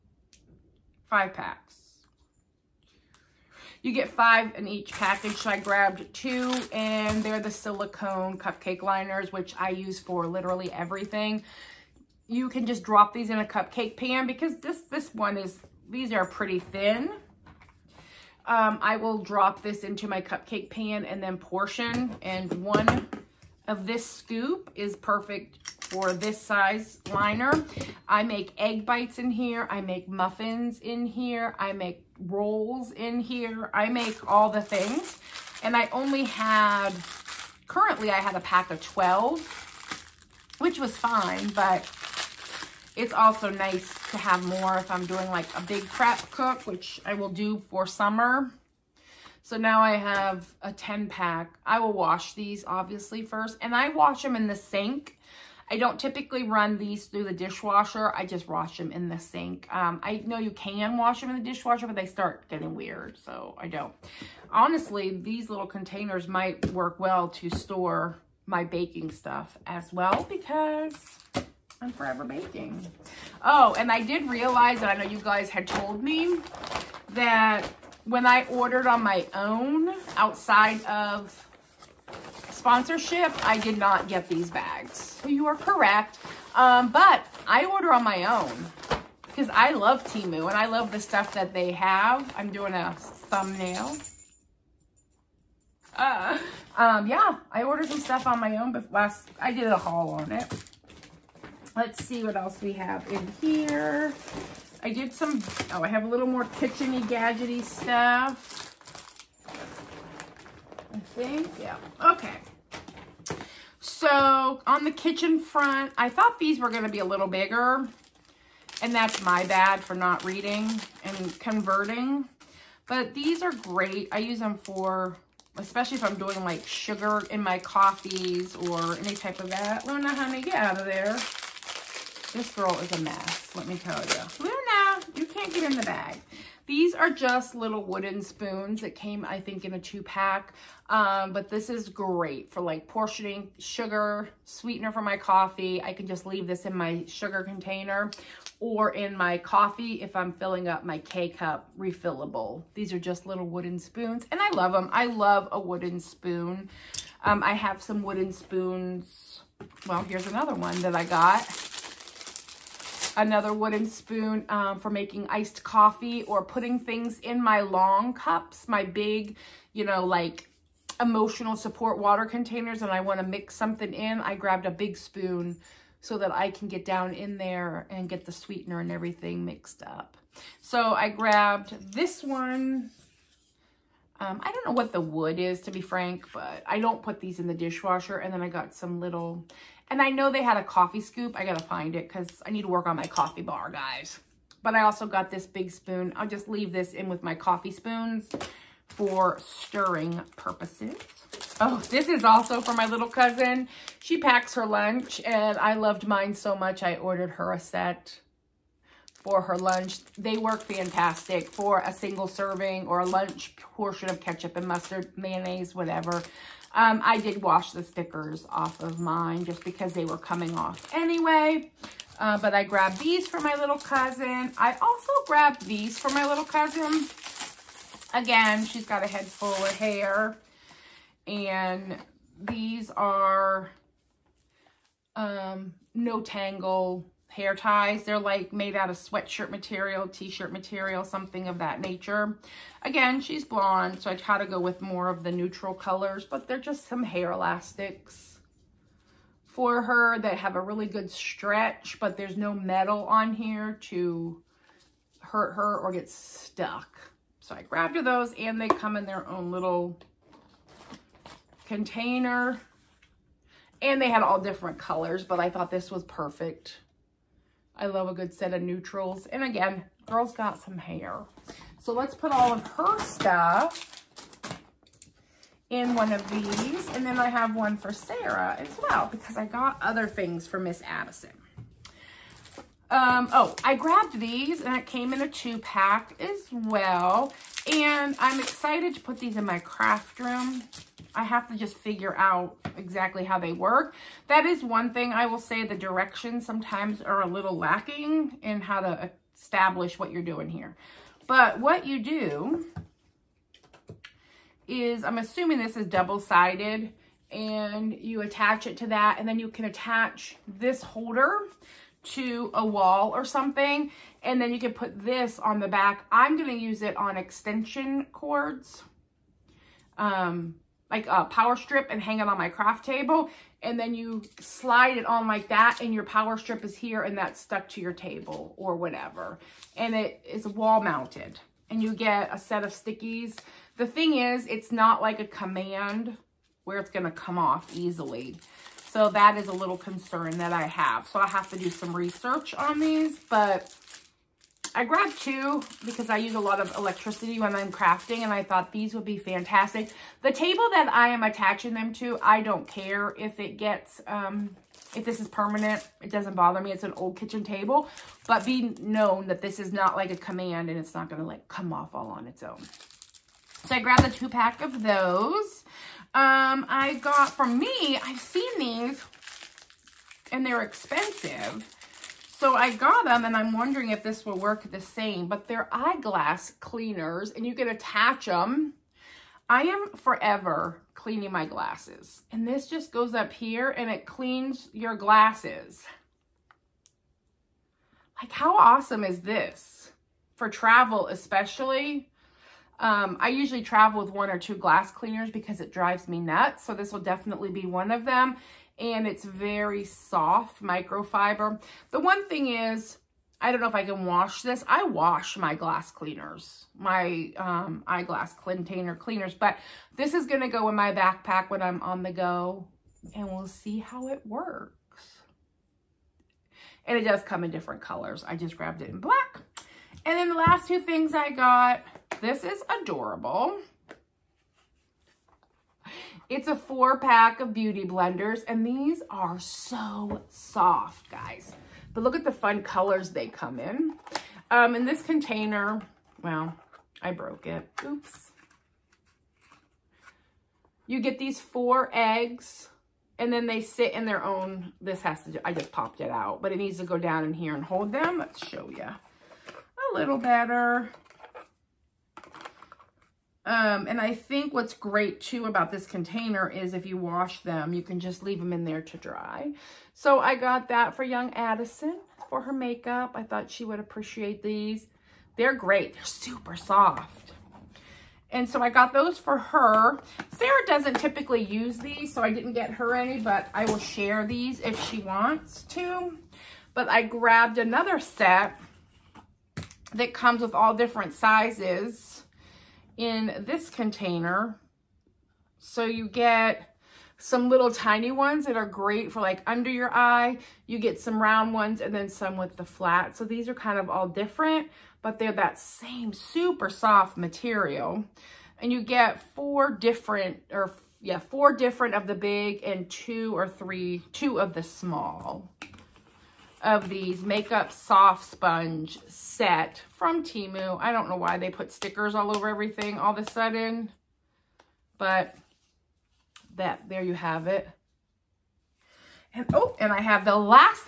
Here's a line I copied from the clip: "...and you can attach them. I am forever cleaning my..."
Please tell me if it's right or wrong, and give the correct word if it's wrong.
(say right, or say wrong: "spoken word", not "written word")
right.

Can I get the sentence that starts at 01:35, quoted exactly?
Uh, um, yeah, I ordered some stuff on my own, but last, I did a haul on it.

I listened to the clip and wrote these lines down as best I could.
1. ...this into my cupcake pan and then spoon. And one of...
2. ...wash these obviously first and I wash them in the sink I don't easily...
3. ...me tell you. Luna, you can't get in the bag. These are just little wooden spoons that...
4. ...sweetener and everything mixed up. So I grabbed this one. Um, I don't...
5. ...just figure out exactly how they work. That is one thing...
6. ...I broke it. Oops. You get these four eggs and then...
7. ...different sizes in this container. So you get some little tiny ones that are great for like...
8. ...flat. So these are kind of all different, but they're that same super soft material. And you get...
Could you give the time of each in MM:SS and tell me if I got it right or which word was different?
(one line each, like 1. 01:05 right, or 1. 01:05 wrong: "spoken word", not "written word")
1. 00:19 wrong: "portion", not "spoon"
2. 00:51 wrong: "typically", not "easily"
3. 02:13 right
4. 02:58 right
5. 04:51 right
6. 07:17 right
7. 08:00 right
8. 08:12 right.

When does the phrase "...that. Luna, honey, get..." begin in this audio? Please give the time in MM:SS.
02:09.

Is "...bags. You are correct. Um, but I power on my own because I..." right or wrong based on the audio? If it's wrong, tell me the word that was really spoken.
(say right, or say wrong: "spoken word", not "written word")
wrong: "order", not "power".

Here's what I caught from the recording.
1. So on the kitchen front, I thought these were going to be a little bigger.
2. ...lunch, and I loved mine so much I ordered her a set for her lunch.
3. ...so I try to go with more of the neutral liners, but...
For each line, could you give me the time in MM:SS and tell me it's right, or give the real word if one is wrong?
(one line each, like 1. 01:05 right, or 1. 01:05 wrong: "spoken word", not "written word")
1. 01:53 right
2. 03:24 right
3. 04:04 wrong: "colors", not "liners".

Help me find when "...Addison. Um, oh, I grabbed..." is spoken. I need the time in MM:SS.
04:40.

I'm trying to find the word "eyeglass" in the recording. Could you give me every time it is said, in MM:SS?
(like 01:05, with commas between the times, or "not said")
06:15, 06:47.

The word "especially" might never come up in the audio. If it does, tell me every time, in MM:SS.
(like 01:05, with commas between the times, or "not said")
02:05, 06:31.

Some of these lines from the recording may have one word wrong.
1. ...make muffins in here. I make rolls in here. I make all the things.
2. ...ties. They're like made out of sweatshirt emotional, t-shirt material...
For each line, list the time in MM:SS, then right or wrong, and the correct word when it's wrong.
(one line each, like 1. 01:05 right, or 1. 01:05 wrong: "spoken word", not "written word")
1. 00:29 right
2. 03:57 wrong: "material", not "emotional".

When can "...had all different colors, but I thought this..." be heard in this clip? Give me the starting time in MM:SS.
04:24.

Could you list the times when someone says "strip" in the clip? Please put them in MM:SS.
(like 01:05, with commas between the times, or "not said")
05:21, 05:26.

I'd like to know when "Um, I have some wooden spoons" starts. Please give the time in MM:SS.
02:37.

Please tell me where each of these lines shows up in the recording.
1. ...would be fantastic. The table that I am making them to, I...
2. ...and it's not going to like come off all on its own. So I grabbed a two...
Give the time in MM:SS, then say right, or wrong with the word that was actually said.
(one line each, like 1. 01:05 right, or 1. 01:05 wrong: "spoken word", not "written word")
1. 05:48 wrong: "attaching", not "making"
2. 06:00 right.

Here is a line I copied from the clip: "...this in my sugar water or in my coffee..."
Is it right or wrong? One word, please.
wrong.